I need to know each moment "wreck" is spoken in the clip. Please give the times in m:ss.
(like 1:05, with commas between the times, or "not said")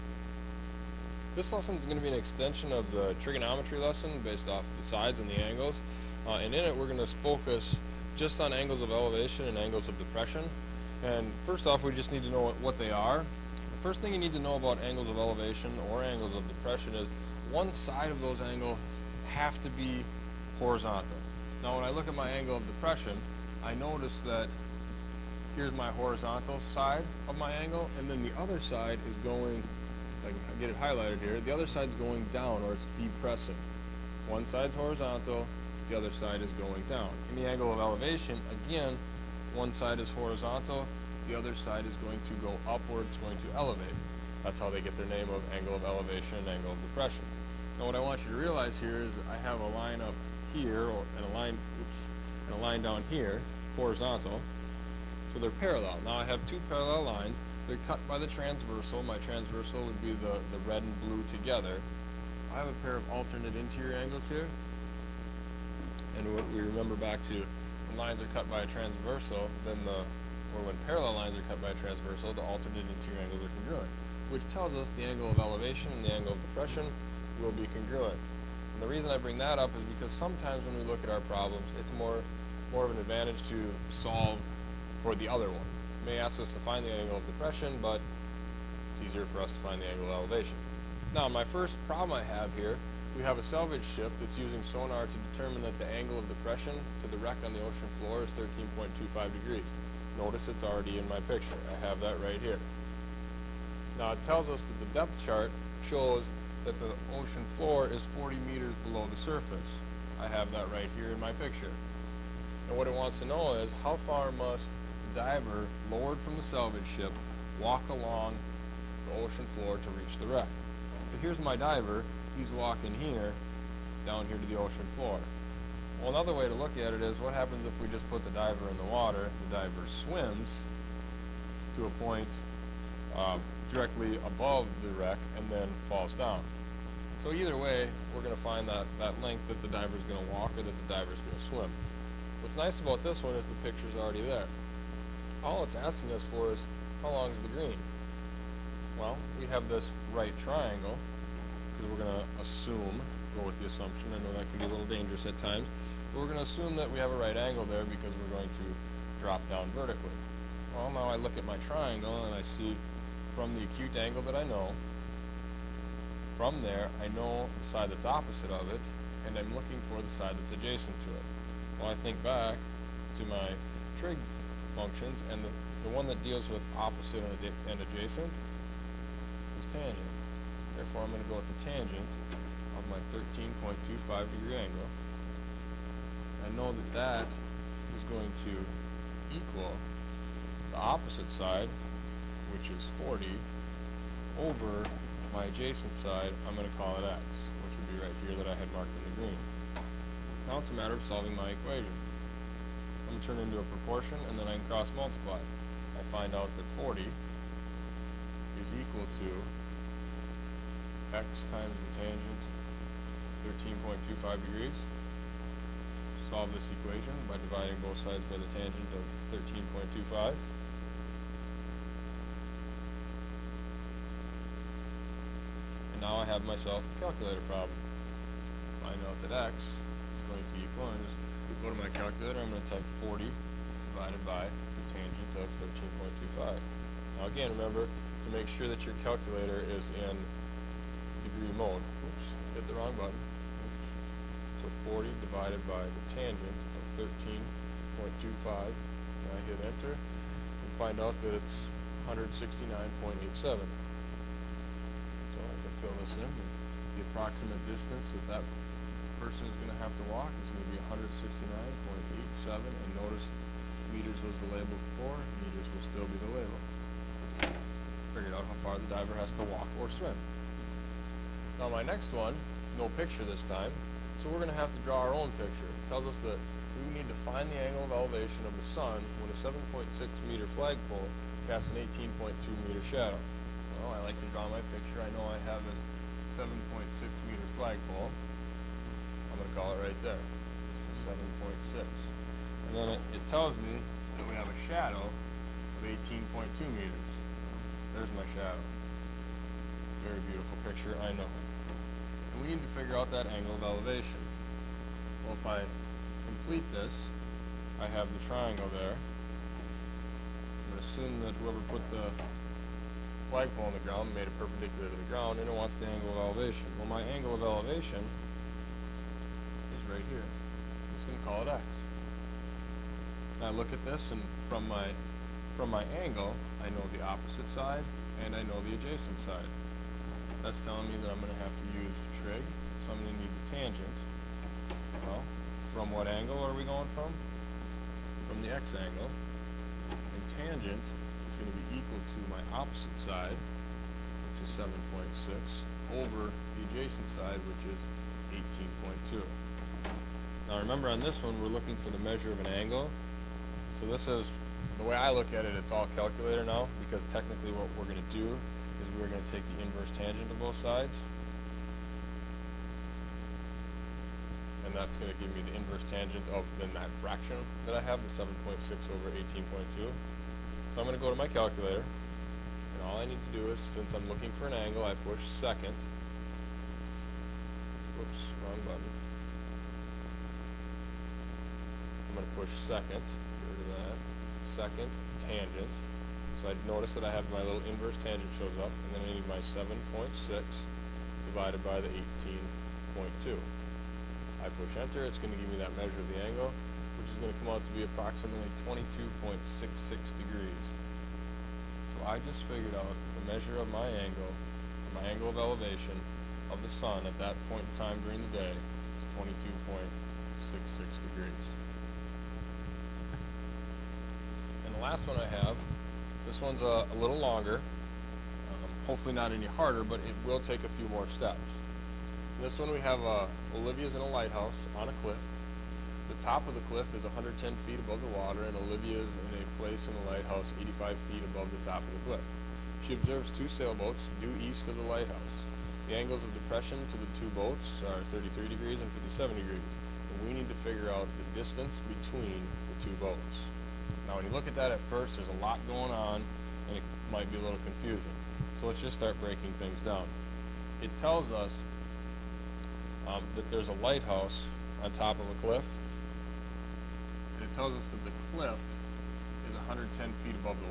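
1:37, 2:00, 2:14.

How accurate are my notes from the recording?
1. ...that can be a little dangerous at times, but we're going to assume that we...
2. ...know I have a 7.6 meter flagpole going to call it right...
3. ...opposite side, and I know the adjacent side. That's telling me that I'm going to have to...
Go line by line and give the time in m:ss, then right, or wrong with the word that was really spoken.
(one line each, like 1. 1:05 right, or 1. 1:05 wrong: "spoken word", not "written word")
1. 2:34 right
2. 4:45 right
3. 5:27 right.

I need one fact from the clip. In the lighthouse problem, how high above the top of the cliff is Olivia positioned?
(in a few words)
85 feet.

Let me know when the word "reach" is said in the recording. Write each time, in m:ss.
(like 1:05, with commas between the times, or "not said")
1:59.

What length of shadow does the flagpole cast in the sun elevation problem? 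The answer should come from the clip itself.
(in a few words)
18.2 meters.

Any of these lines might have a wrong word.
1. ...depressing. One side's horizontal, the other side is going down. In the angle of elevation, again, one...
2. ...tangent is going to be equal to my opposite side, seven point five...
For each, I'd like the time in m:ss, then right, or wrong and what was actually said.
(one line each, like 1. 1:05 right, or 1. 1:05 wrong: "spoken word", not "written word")
1. 0:32 right
2. 5:40 wrong: "six", not "five".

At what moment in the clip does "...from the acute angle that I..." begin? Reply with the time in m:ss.
2:43.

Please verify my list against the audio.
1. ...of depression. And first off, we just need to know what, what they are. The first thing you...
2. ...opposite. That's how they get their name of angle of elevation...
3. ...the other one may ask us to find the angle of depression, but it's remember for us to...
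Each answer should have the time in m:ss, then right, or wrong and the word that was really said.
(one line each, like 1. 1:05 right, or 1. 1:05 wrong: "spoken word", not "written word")
1. 0:09 right
2. 0:43 wrong: "elevate", not "opposite"
3. 1:25 wrong: "easier", not "remember".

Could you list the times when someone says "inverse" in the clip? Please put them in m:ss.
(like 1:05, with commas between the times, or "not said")
5:59, 6:05, 6:27.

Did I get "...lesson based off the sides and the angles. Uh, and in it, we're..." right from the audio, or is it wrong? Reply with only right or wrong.
right.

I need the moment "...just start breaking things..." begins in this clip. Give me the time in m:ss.
7:28.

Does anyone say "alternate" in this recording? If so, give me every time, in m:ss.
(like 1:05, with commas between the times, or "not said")
1:03, 1:12.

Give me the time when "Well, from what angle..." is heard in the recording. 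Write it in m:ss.
5:35.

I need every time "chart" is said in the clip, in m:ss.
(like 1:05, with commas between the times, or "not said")
1:45.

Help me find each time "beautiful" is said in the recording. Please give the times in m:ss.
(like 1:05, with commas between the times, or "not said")
5:00.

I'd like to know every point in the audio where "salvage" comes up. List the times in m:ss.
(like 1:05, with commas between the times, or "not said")
1:33, 1:56.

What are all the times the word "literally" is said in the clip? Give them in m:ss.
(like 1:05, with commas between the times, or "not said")
not said.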